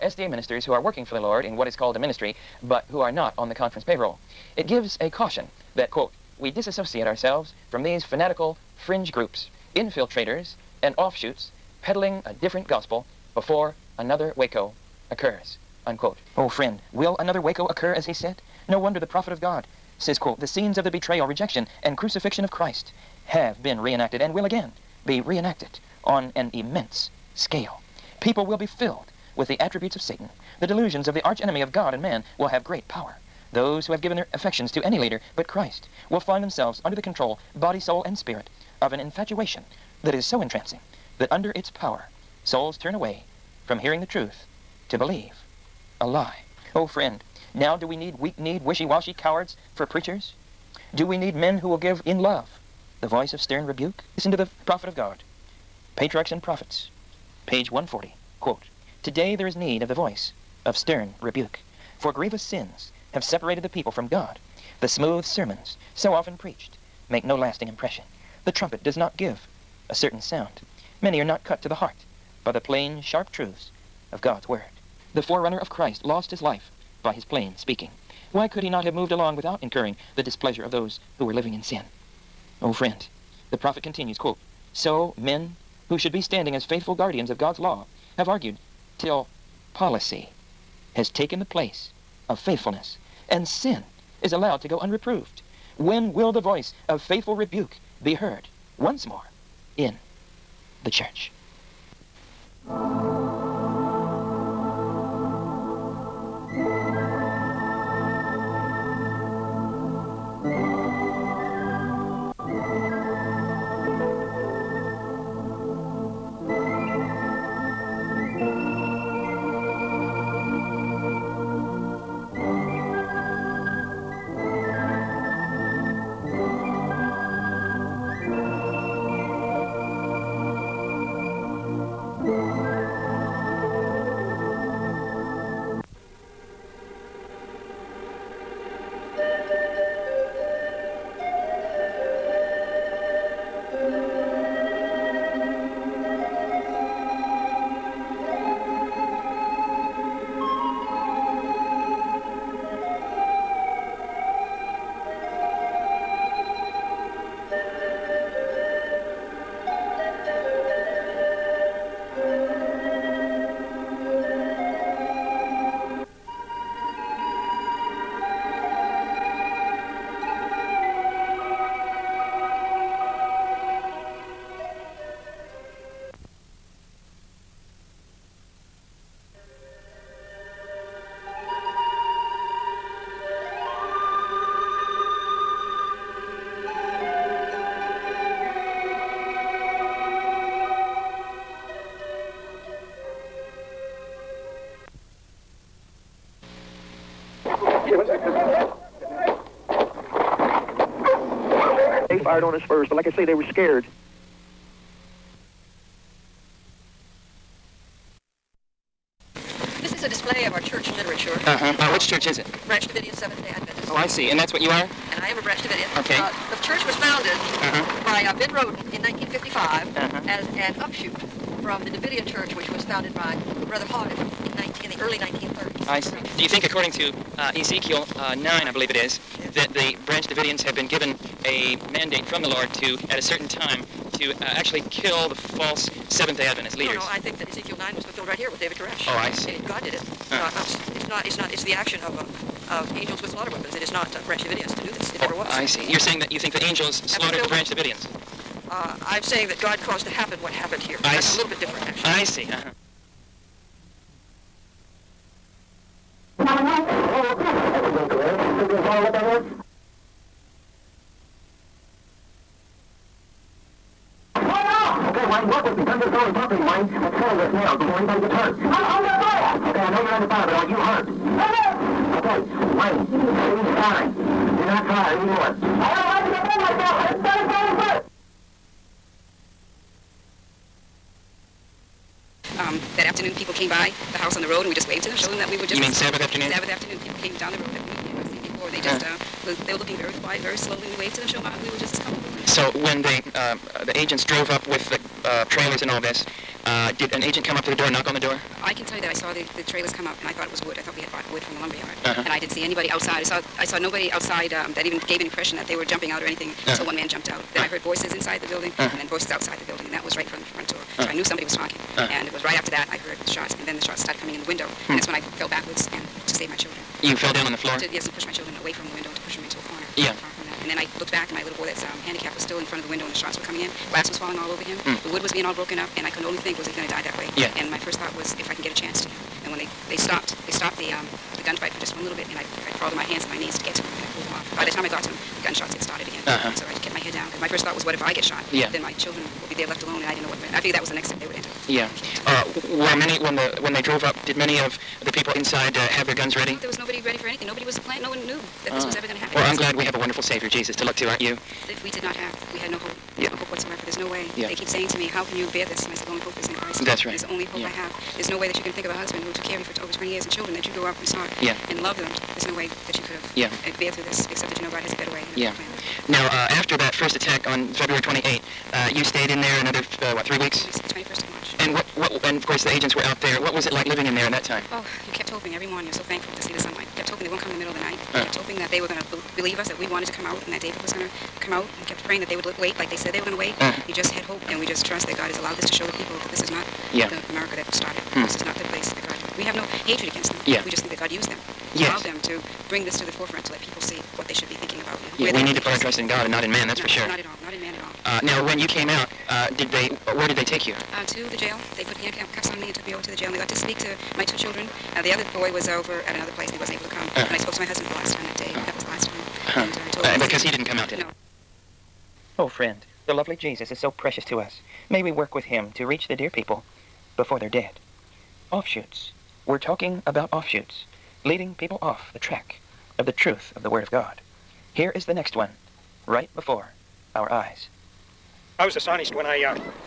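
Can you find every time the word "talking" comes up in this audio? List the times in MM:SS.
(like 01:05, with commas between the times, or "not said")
05:11, 06:59.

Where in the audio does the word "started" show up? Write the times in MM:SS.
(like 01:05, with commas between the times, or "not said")
05:13, 05:35, 06:27.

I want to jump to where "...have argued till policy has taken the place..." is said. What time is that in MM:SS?
01:28.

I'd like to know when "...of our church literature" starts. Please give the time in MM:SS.
03:30.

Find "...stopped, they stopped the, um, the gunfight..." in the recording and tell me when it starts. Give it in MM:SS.
05:29.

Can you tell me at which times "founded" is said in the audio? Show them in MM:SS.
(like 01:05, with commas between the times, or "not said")
03:36, 03:42.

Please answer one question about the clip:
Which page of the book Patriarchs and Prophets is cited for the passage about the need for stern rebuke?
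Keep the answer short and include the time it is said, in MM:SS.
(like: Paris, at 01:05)
140, at 00:57.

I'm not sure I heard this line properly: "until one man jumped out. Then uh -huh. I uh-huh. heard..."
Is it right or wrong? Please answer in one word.
right.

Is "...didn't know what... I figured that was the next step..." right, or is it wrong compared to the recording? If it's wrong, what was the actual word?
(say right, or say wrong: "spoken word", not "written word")
right.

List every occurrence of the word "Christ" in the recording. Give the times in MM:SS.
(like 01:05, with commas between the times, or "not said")
00:22, 00:35, 01:15, 05:56.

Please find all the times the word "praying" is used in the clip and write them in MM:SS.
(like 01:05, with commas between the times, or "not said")
06:22.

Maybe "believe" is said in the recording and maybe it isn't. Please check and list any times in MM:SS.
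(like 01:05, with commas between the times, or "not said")
00:44, 03:48, 06:19.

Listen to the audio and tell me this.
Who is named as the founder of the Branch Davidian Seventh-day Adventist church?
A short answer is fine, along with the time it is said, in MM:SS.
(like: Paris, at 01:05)
Ben Roden, at 03:38.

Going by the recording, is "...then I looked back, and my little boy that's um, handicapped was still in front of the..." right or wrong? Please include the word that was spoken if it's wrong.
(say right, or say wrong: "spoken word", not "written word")
right.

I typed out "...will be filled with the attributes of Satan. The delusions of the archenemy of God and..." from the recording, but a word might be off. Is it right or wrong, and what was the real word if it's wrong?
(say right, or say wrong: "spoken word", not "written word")
right.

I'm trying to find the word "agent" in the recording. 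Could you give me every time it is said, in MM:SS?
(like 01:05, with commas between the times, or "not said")
04:57, 06:12.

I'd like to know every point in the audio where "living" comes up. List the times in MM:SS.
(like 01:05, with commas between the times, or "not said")
01:21, 06:13.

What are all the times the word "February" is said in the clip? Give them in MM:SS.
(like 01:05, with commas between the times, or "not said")
06:07.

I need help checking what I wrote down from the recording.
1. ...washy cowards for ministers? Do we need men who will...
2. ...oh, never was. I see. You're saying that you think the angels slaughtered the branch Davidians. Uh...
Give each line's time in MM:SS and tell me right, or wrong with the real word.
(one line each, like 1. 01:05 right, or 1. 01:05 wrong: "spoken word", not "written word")
1. 00:48 wrong: "preachers", not "ministers"
2. 04:05 right.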